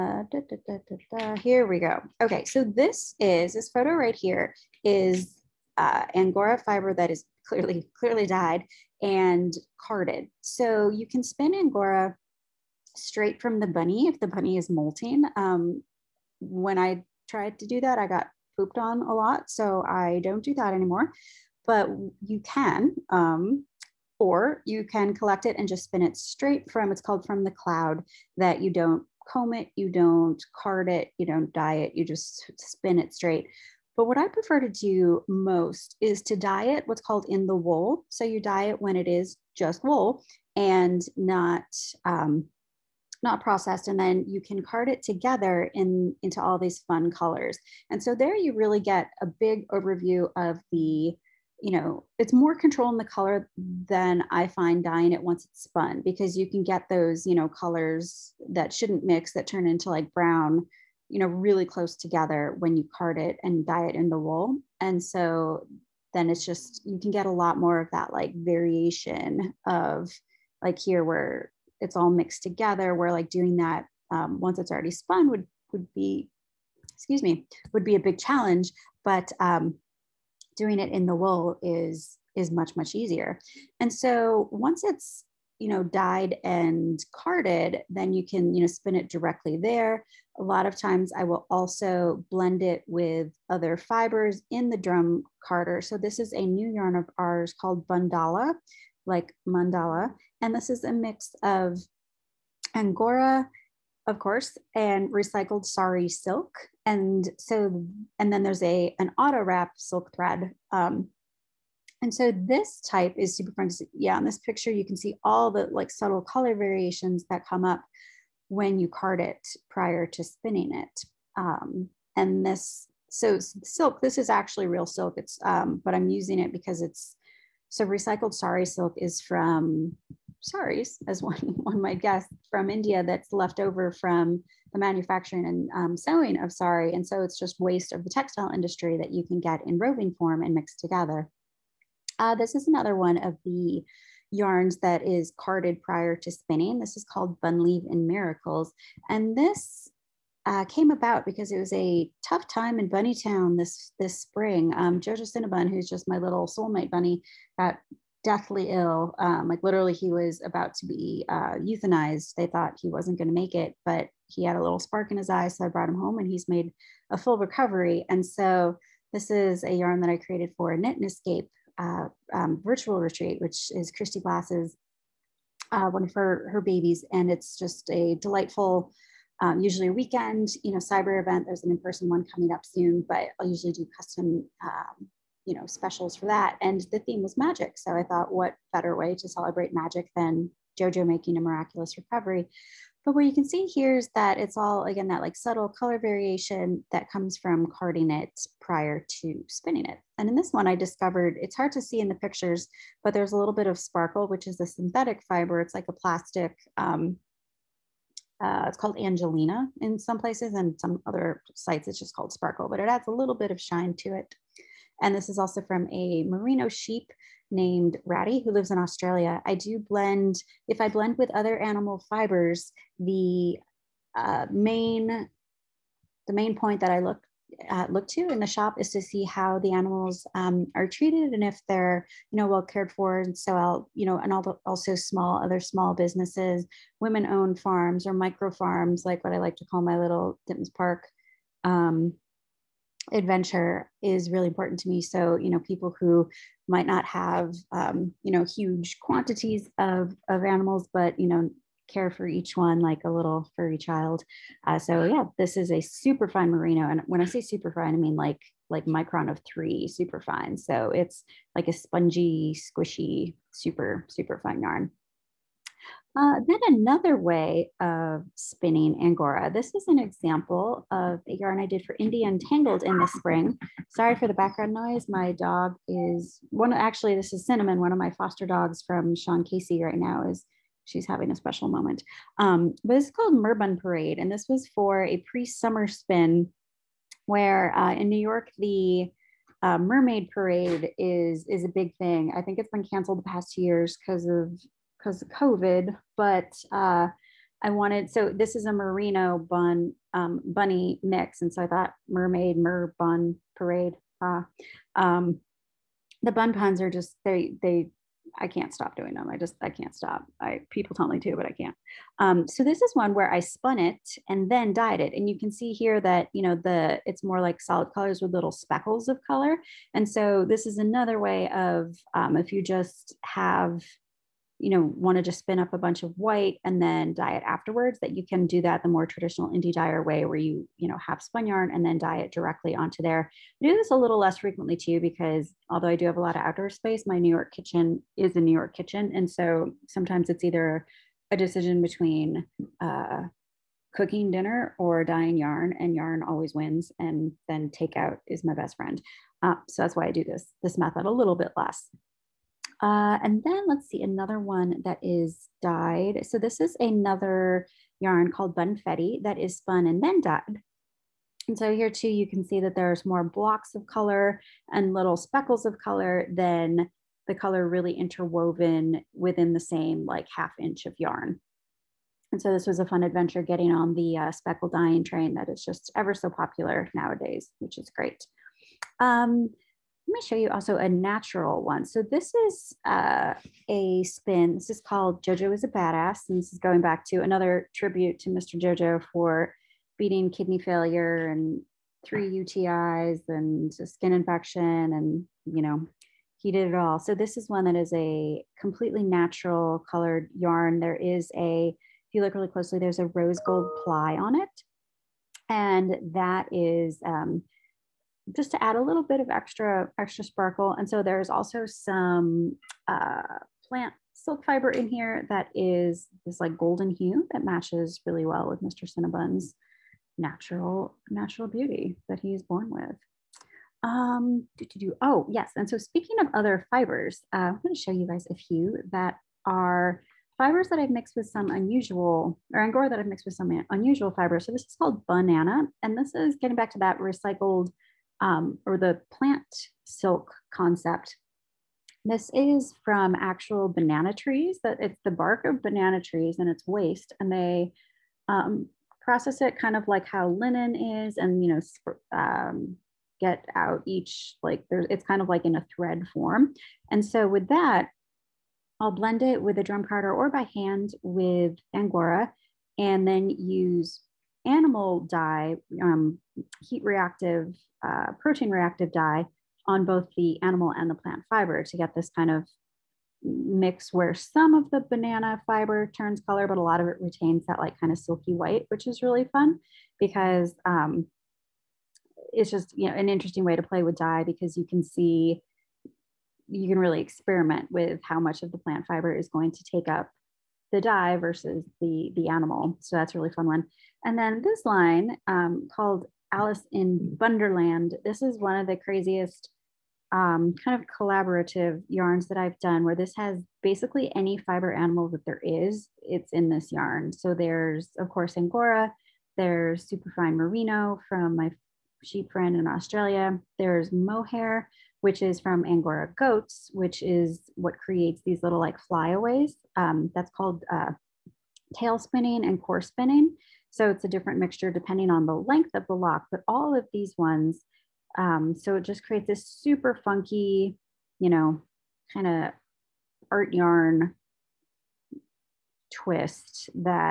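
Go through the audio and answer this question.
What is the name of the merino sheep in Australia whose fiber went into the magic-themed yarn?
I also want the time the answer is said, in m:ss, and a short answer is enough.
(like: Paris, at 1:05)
Ratty, at 3:38.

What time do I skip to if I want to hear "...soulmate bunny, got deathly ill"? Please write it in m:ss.
2:36.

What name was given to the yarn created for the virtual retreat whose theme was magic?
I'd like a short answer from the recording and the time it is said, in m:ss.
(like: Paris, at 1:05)
Leave and Miracles, at 2:27.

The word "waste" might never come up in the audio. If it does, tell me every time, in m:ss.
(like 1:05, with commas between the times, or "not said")
2:17, 7:26.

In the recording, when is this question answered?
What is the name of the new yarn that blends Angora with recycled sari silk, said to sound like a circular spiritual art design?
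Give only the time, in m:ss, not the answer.
1:37.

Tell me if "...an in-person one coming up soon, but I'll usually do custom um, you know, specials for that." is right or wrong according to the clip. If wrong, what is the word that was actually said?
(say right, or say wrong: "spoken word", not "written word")
right.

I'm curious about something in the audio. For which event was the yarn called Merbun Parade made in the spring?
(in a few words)
Indie Untangled.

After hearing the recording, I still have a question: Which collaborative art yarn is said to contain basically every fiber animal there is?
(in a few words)
Alice in Wonderland.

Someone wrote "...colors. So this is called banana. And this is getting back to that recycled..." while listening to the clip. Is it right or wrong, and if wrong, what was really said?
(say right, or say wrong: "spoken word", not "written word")
wrong: "fibers", not "colors".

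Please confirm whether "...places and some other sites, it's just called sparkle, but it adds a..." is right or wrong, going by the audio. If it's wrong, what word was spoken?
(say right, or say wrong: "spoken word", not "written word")
right.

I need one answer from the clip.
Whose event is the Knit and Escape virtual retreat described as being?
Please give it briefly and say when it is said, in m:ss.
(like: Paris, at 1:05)
Christy Glass, at 2:53.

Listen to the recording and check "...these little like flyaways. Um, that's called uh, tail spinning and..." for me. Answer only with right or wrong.
right.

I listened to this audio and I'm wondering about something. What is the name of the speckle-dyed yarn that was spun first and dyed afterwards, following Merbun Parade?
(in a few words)
Bunfetti.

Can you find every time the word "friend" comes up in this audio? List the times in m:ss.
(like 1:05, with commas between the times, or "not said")
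5:48, 8:32.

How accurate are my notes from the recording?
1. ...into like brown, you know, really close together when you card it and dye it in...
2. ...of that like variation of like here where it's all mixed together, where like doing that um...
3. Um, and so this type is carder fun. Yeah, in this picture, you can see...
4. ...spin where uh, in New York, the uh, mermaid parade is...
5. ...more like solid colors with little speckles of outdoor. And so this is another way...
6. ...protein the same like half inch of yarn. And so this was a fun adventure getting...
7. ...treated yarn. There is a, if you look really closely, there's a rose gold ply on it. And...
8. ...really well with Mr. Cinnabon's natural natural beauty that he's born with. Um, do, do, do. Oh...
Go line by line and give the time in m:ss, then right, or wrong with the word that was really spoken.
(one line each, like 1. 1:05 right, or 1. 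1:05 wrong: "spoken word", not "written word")
1. 0:59 right
2. 1:07 right
3. 1:50 wrong: "super", not "carder"
4. 4:45 right
5. 5:17 wrong: "color", not "outdoor"
6. 6:09 wrong: "within", not "protein"
7. 6:39 wrong: "colored", not "treated"
8. 6:58 right.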